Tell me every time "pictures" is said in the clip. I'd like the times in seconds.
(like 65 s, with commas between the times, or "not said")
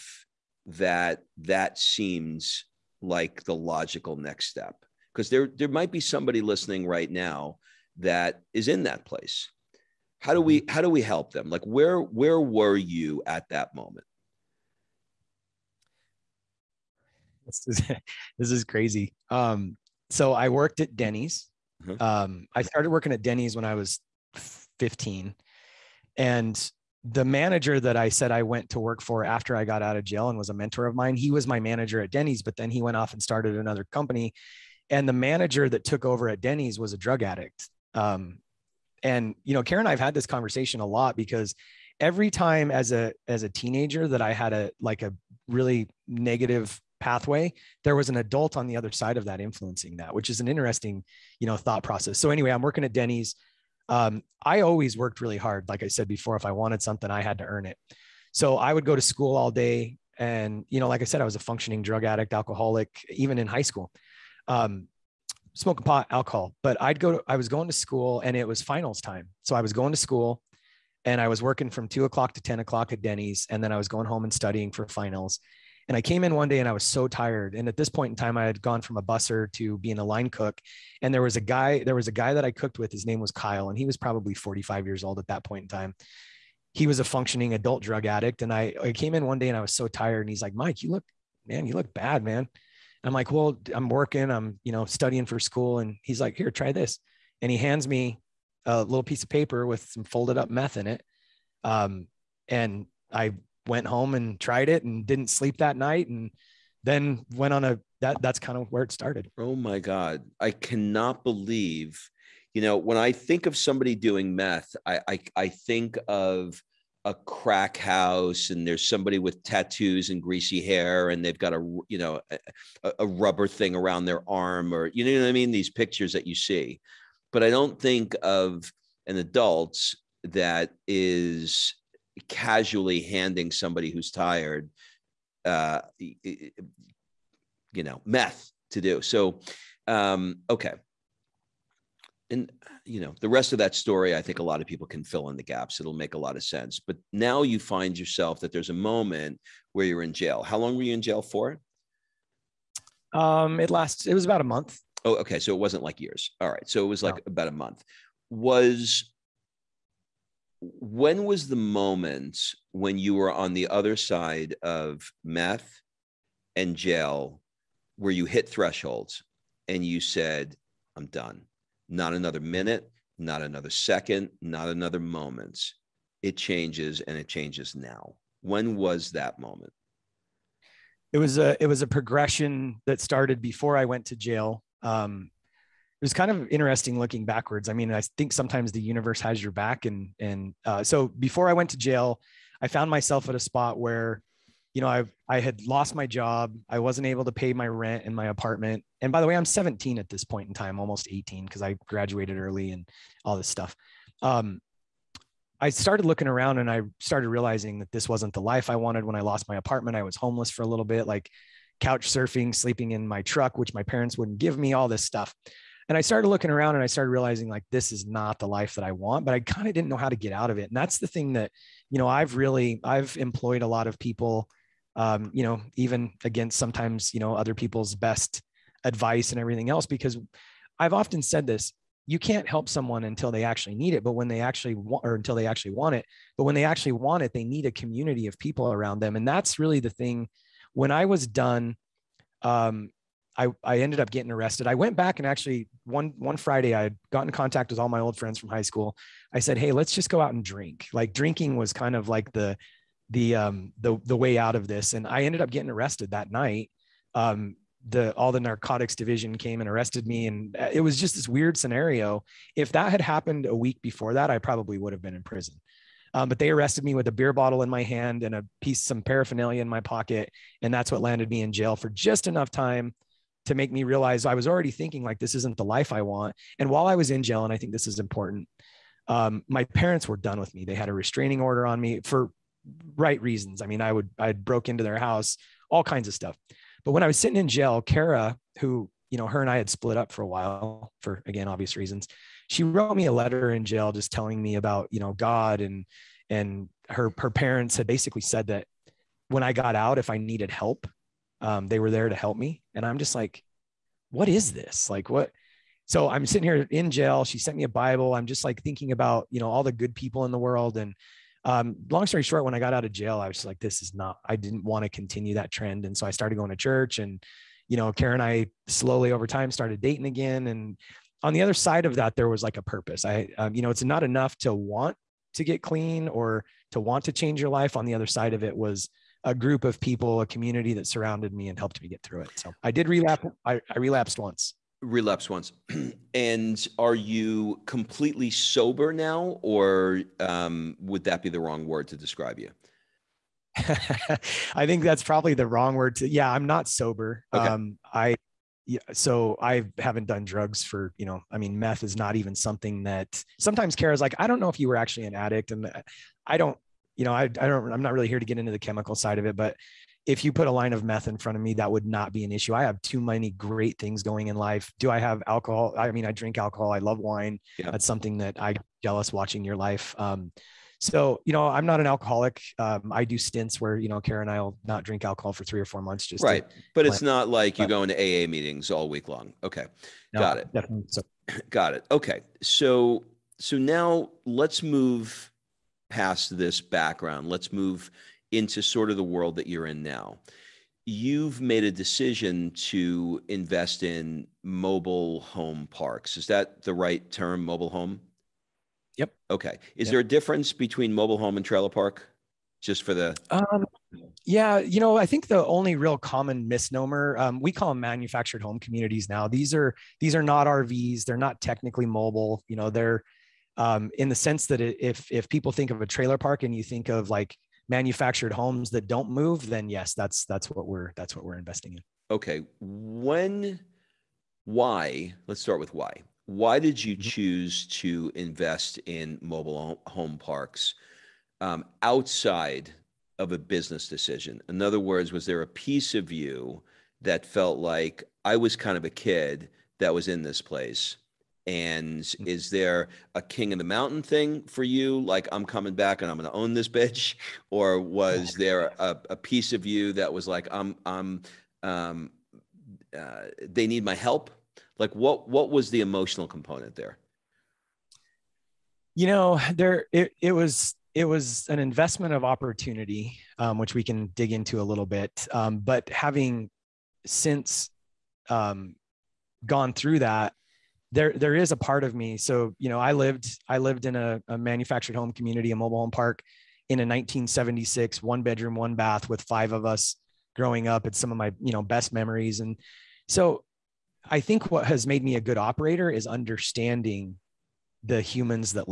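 125 s.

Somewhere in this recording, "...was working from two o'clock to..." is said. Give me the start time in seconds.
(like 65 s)
71 s.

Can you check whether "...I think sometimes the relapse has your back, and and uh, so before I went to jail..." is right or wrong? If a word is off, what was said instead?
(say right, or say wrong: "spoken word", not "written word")
wrong: "universe", not "relapse".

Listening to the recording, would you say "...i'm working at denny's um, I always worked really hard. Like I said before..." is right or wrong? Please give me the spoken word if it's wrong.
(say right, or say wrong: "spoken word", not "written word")
right.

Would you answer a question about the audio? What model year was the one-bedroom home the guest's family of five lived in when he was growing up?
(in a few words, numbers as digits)
1976.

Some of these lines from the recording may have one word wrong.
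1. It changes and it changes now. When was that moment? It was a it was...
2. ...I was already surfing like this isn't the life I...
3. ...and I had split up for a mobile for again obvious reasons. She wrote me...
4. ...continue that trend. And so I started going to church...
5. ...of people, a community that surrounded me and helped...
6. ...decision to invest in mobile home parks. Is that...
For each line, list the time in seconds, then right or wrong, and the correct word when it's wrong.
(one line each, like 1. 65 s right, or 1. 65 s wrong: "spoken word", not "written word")
1. 176 s right
2. 274 s wrong: "thinking", not "surfing"
3. 289 s wrong: "while", not "mobile"
4. 314 s right
5. 329 s right
6. 391 s right.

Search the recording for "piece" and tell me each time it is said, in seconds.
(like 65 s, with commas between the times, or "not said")
99 s, 268 s, 435 s, 449 s.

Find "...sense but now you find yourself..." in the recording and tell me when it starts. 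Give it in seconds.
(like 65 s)
146 s.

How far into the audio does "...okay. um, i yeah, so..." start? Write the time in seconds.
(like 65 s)
347 s.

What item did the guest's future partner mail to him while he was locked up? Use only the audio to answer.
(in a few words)
A Bible.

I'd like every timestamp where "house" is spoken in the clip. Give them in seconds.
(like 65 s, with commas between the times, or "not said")
117 s, 284 s.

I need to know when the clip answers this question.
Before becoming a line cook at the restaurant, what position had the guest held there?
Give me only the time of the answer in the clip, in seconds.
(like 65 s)
78 s.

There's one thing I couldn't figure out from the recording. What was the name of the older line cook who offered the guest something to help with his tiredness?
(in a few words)
Kyle.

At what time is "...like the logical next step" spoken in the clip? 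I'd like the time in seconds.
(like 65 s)
3 s.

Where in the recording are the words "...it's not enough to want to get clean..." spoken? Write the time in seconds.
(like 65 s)
323 s.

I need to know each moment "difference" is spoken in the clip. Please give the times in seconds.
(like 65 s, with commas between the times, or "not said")
400 s.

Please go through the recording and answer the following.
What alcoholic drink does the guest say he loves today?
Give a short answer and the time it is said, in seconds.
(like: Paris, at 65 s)
Wine, at 366 s.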